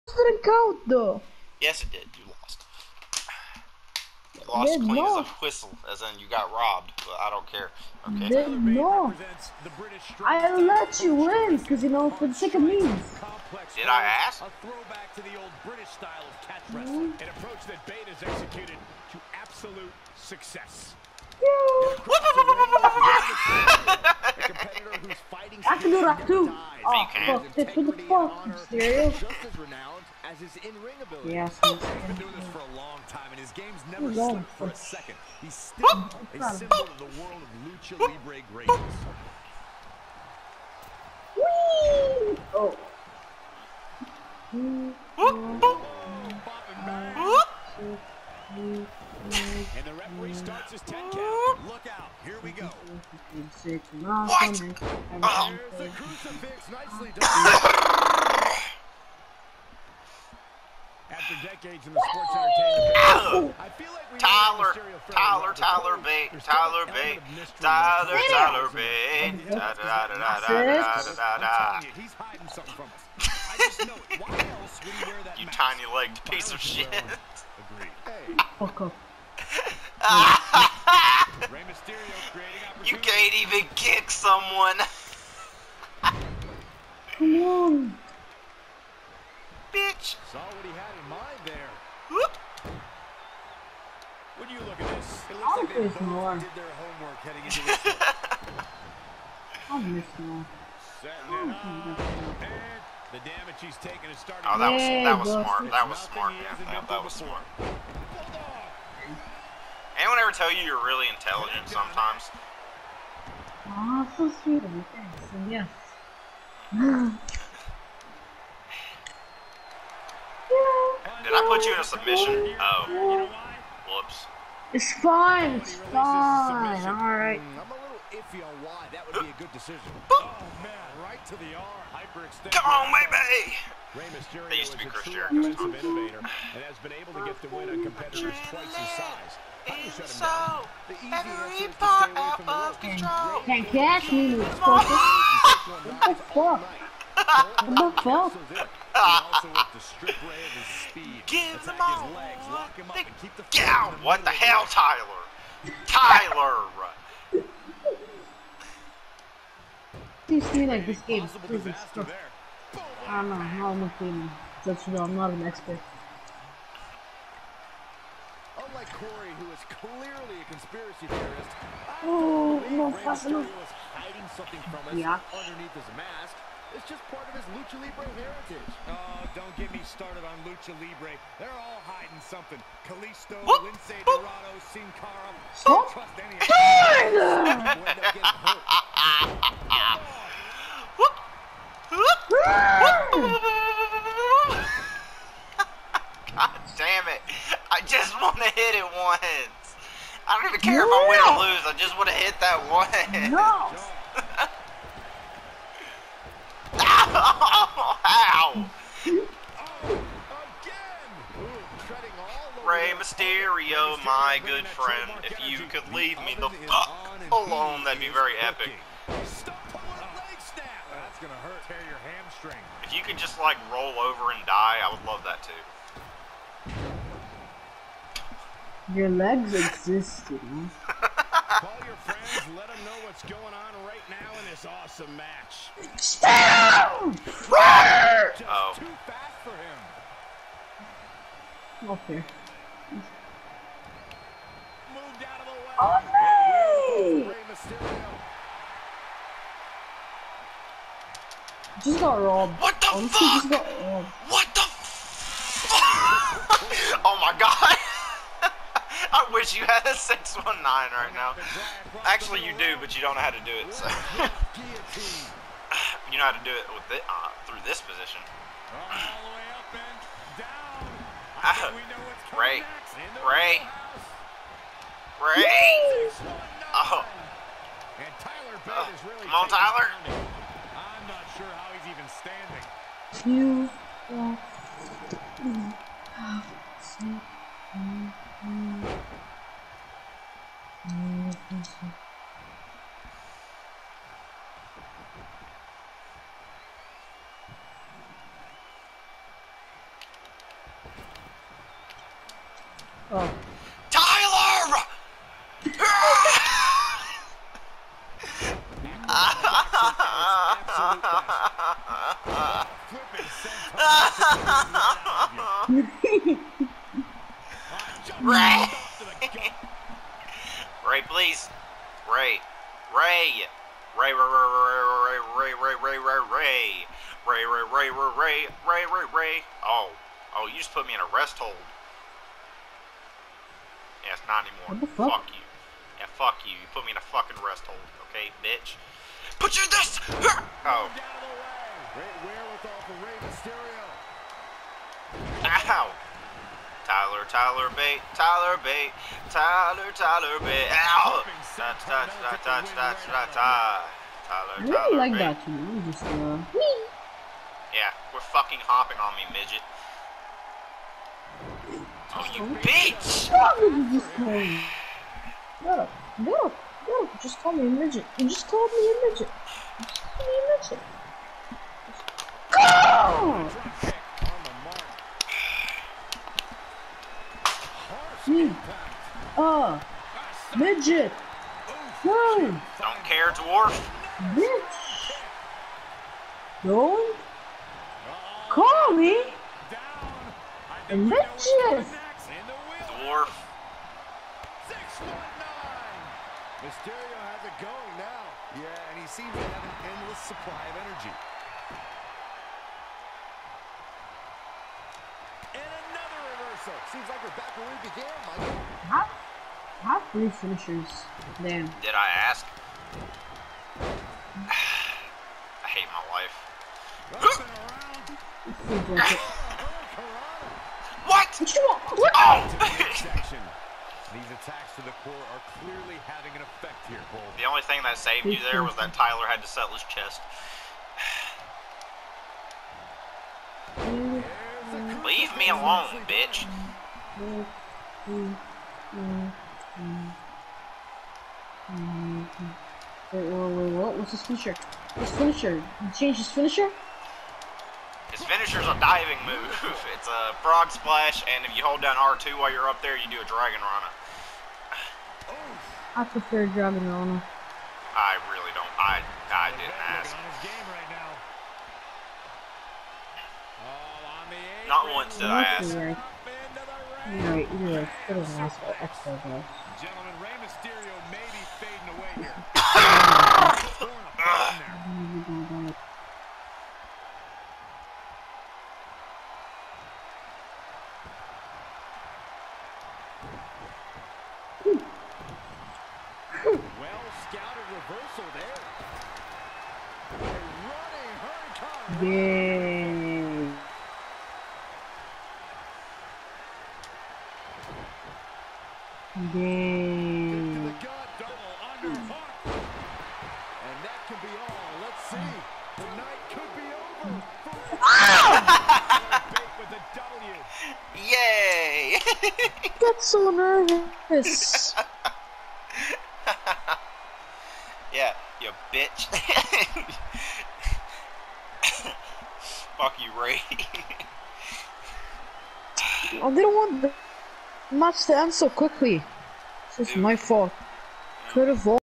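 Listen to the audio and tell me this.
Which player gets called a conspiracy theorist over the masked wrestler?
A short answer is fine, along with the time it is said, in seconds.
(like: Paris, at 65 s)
Corey, at 168 s.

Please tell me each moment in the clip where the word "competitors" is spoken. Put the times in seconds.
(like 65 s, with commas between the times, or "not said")
137 s.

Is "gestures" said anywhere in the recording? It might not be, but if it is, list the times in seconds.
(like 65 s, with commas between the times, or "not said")
not said.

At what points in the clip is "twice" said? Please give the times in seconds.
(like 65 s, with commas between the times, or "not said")
138 s.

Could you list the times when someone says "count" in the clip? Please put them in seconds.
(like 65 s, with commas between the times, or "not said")
0 s, 51 s.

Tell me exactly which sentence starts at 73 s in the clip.
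I just know Why else would he wear that You tiny-legged piece of shit.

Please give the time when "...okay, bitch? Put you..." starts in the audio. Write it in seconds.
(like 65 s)
338 s.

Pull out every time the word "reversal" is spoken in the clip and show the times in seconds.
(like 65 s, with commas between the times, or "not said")
406 s, 487 s.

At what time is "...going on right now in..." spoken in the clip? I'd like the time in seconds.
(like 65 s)
233 s.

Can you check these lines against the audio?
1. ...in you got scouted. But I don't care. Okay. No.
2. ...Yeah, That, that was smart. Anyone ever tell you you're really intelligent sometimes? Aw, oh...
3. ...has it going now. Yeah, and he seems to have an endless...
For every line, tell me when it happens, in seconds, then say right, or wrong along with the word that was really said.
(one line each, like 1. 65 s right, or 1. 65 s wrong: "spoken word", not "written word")
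1. 6 s wrong: "robbed", not "scouted"
2. 106 s right
3. 397 s right.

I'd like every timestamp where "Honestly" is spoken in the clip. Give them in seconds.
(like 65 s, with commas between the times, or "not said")
252 s.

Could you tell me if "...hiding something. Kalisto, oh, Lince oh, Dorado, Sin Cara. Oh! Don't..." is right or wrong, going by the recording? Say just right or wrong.
right.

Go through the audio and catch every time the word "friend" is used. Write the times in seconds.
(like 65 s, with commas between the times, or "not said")
214 s, 231 s.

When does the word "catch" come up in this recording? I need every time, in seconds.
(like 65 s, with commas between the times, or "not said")
16 s, 143 s.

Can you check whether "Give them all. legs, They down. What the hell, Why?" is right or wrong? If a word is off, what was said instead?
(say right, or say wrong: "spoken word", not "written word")
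wrong: "Tyler", not "Why".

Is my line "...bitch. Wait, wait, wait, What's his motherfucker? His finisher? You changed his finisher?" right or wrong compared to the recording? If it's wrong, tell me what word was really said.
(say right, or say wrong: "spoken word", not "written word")
wrong: "finisher", not "motherfucker".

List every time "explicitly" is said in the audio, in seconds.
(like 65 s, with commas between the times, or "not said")
not said.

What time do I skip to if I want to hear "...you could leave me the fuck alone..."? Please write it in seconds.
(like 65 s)
215 s.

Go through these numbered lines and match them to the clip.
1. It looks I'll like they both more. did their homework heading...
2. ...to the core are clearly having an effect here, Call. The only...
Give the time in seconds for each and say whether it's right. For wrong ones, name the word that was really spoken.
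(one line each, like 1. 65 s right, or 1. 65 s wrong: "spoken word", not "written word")
1. 95 s right
2. 424 s wrong: "Bull", not "Call".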